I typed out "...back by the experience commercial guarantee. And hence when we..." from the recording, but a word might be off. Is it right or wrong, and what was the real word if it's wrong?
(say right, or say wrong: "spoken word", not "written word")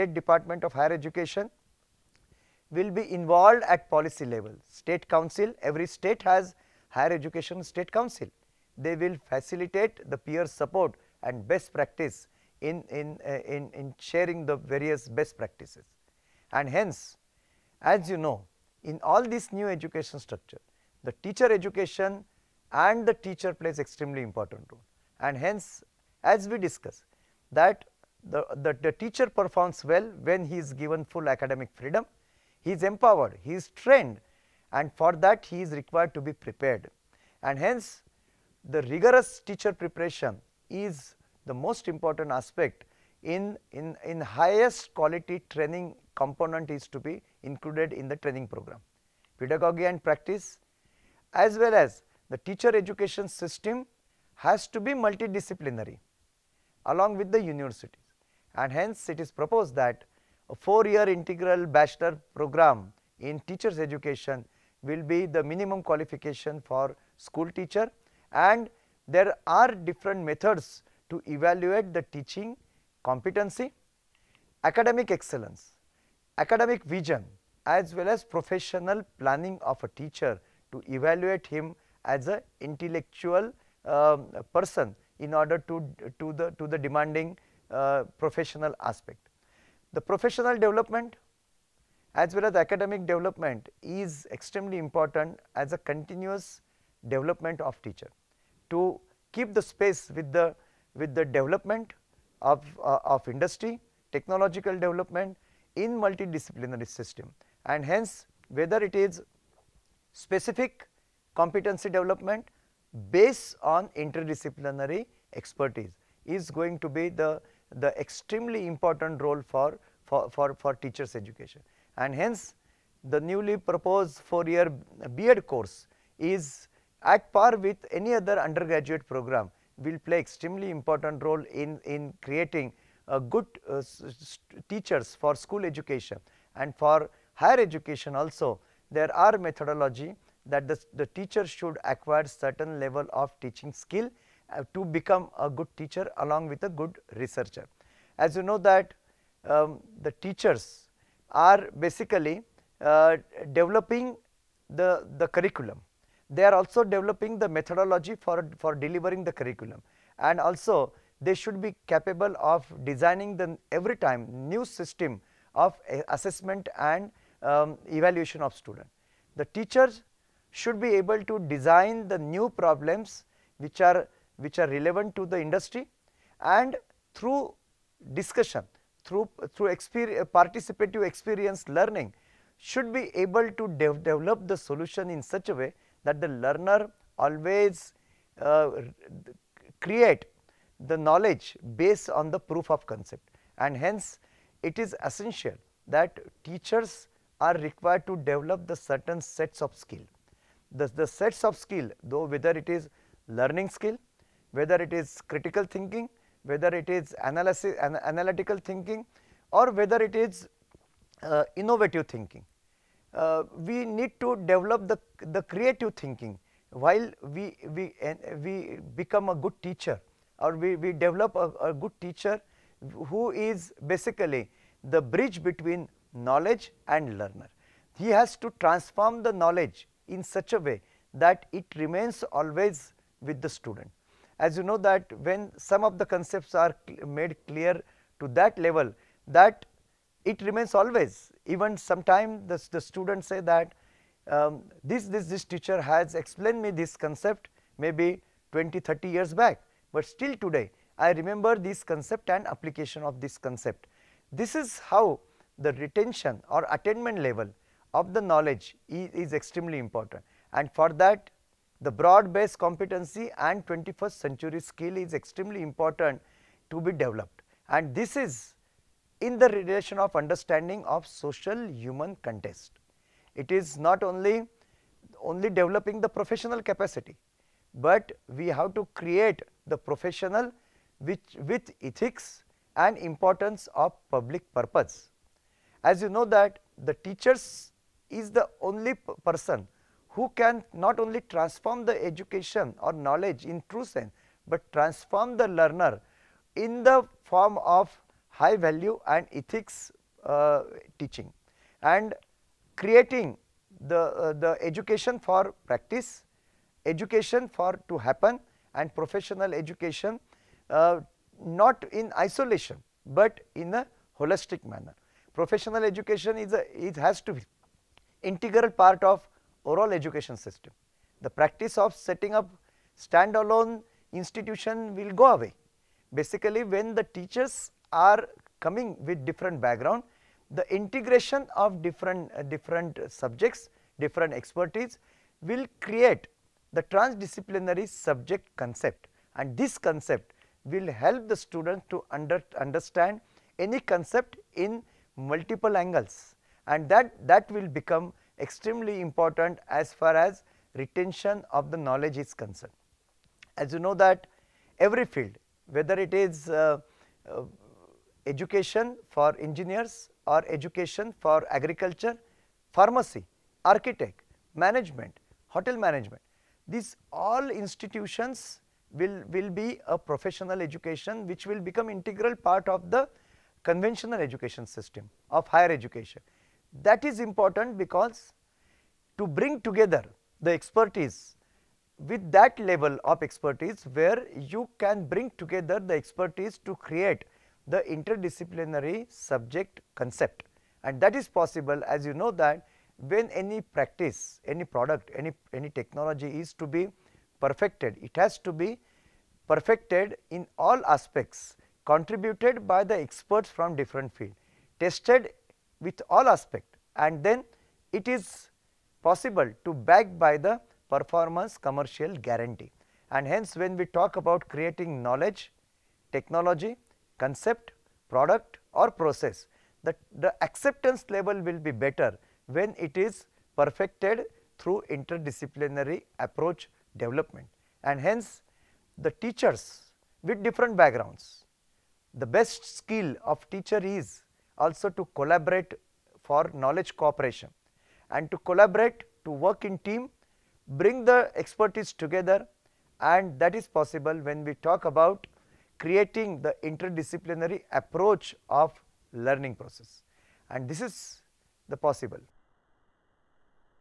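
wrong: "performance", not "experience".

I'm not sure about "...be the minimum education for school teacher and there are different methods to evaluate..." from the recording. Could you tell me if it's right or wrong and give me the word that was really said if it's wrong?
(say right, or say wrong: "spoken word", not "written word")
wrong: "qualification", not "education".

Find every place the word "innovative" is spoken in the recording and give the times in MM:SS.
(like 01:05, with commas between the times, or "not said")
03:31.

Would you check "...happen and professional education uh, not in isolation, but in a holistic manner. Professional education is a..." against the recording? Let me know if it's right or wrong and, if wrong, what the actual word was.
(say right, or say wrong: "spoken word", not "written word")
right.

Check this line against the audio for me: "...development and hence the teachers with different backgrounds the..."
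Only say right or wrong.
right.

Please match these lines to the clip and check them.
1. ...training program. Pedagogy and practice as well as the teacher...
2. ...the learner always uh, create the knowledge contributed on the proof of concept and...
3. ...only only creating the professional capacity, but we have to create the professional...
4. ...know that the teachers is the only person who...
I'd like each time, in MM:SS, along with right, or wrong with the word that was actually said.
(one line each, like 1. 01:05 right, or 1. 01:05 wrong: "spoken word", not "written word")
1. 00:48 right
2. 03:06 wrong: "based", not "contributed"
3. 04:34 wrong: "developing", not "creating"
4. 04:46 right.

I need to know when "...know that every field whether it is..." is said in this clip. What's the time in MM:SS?
05:53.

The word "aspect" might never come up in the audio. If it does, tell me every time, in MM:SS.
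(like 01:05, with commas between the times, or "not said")
00:42, 01:28, 06:40, 06:46.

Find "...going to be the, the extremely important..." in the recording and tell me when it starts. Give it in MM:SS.
01:56.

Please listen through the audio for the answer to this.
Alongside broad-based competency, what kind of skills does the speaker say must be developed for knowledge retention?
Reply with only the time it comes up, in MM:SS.
04:23.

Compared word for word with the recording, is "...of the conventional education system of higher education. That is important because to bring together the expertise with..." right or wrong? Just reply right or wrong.
right.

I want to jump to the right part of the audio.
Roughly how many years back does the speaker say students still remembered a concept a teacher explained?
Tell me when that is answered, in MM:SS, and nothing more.
04:08.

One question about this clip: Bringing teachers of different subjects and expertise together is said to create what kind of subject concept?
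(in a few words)
Transdisciplinary.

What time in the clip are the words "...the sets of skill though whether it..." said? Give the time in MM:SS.
03:21.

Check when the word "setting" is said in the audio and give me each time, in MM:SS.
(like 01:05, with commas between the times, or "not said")
05:21.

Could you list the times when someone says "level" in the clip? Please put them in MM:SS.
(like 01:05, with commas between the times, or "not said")
00:04, 02:22, 03:58, 04:17, 06:22, 07:01.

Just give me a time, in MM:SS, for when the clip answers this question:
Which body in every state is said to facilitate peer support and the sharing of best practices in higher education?
00:06.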